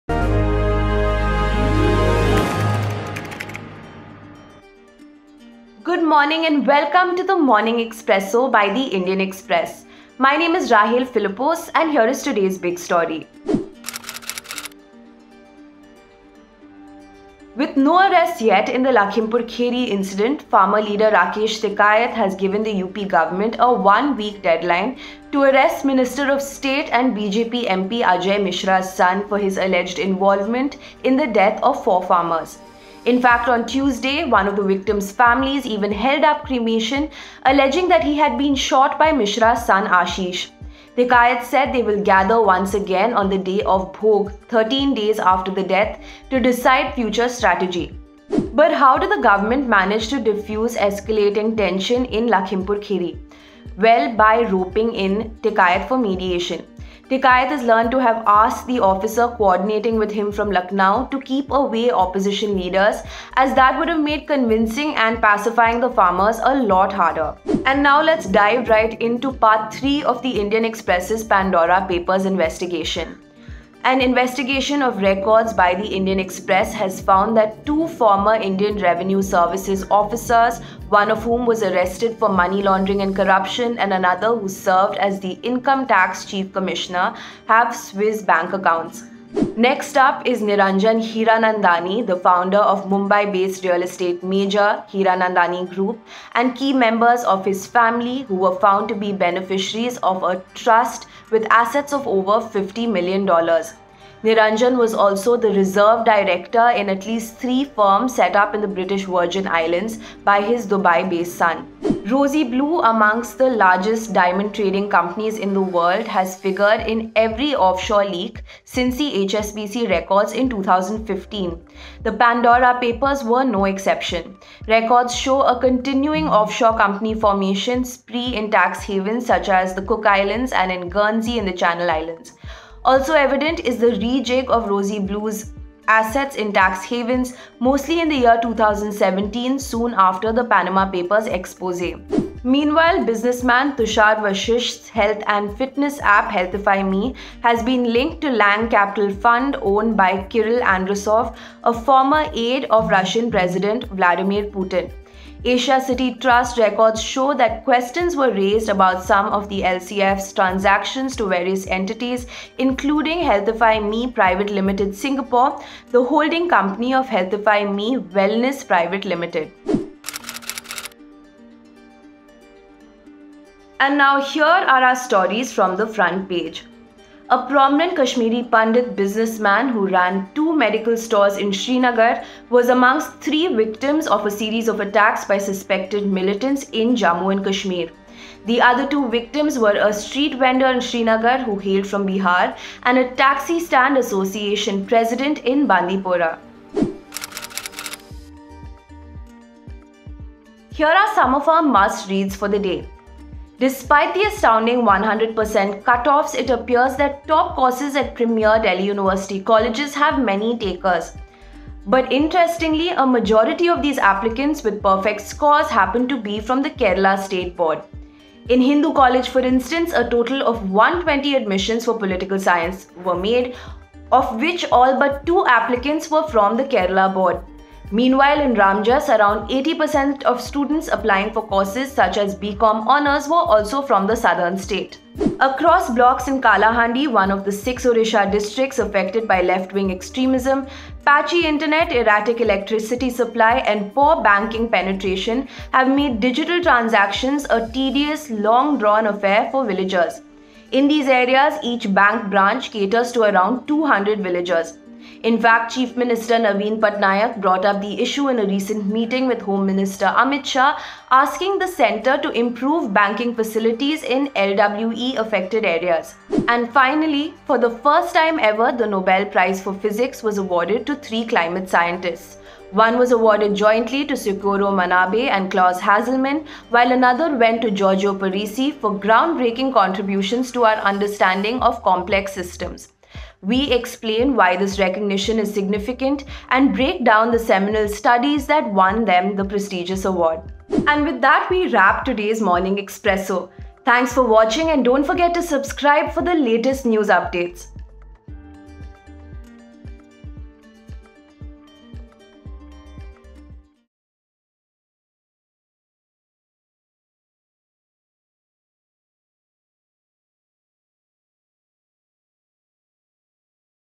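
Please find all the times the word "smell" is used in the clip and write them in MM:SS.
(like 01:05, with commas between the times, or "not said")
not said.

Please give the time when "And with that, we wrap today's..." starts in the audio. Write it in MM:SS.
04:50.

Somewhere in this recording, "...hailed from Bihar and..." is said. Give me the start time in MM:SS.
03:11.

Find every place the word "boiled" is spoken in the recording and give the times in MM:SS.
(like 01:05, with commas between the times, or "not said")
not said.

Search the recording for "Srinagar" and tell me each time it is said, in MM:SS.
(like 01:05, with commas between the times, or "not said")
03:01, 03:10.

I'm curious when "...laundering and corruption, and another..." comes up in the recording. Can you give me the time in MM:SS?
01:22.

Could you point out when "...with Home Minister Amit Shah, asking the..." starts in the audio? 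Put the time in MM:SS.
04:19.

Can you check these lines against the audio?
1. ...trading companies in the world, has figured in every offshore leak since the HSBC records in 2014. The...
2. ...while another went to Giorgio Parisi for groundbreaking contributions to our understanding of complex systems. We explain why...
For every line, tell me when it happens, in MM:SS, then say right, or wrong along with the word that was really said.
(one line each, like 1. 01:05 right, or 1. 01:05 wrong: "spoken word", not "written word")
1. 01:54 wrong: "2015", not "2014"
2. 04:36 right.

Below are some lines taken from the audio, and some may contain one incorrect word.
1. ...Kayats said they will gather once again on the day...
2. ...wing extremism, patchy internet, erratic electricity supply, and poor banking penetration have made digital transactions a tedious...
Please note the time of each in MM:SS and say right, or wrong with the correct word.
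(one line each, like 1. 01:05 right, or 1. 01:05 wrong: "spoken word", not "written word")
1. 00:41 right
2. 03:59 right.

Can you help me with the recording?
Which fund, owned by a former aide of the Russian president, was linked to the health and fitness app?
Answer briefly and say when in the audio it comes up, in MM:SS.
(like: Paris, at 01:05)
Lang Capital Fund, at 02:28.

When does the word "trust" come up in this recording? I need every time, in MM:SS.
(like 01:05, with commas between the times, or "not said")
01:40, 02:36.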